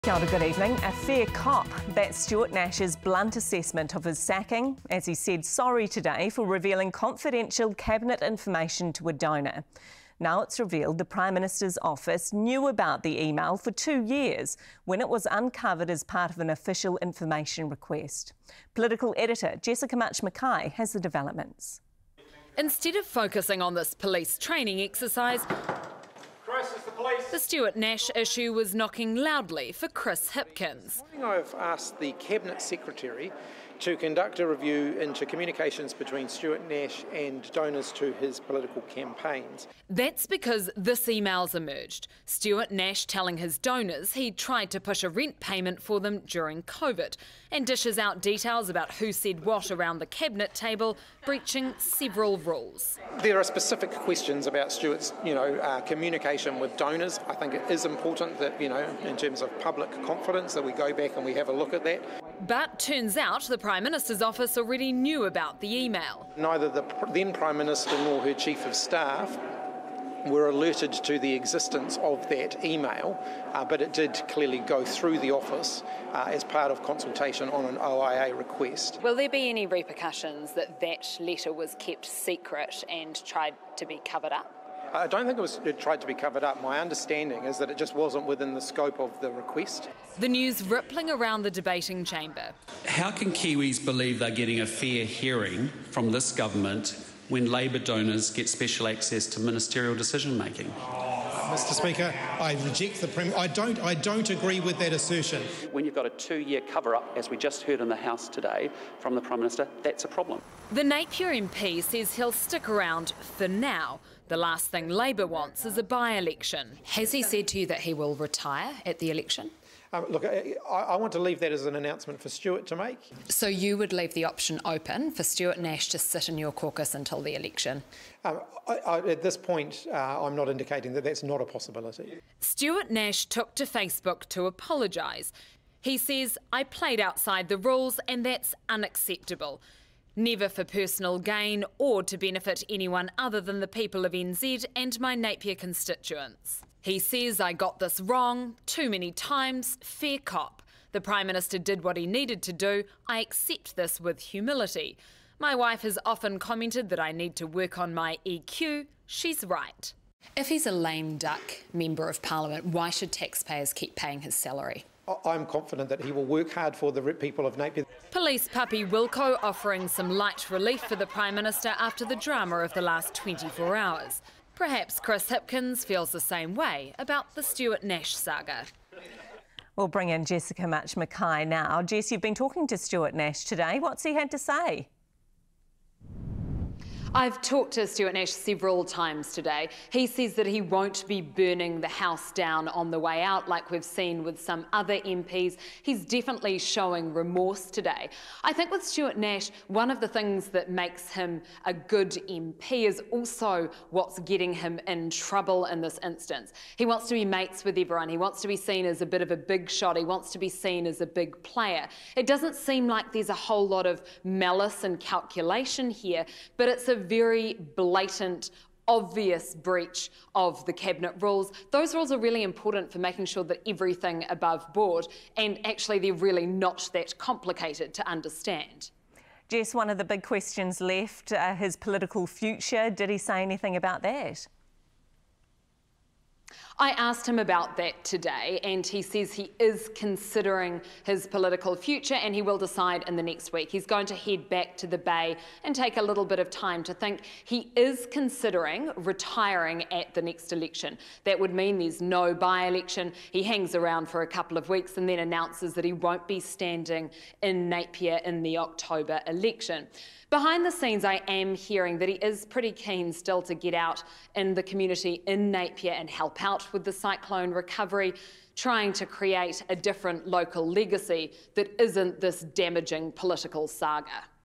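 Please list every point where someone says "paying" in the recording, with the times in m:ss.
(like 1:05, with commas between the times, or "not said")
2:43.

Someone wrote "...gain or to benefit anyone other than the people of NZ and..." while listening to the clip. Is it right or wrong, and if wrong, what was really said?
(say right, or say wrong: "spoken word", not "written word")
right.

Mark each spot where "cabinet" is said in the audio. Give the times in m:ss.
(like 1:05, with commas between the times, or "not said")
0:07, 0:32, 0:50, 3:40.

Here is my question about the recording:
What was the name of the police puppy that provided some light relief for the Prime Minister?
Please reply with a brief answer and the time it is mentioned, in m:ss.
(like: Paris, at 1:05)
Wilco, at 2:48.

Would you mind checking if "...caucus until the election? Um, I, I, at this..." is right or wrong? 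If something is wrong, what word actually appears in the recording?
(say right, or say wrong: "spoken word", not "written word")
right.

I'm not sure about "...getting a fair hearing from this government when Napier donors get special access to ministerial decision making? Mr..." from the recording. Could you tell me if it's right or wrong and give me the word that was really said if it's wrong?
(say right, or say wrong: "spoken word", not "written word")
wrong: "Labor", not "Napier".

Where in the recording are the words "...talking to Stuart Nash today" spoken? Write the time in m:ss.
3:02.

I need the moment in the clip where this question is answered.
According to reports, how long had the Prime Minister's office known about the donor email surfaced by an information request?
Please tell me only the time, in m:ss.
0:13.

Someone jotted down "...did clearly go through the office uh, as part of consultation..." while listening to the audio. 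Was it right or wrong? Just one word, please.
right.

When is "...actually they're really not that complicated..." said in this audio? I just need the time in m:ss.
3:45.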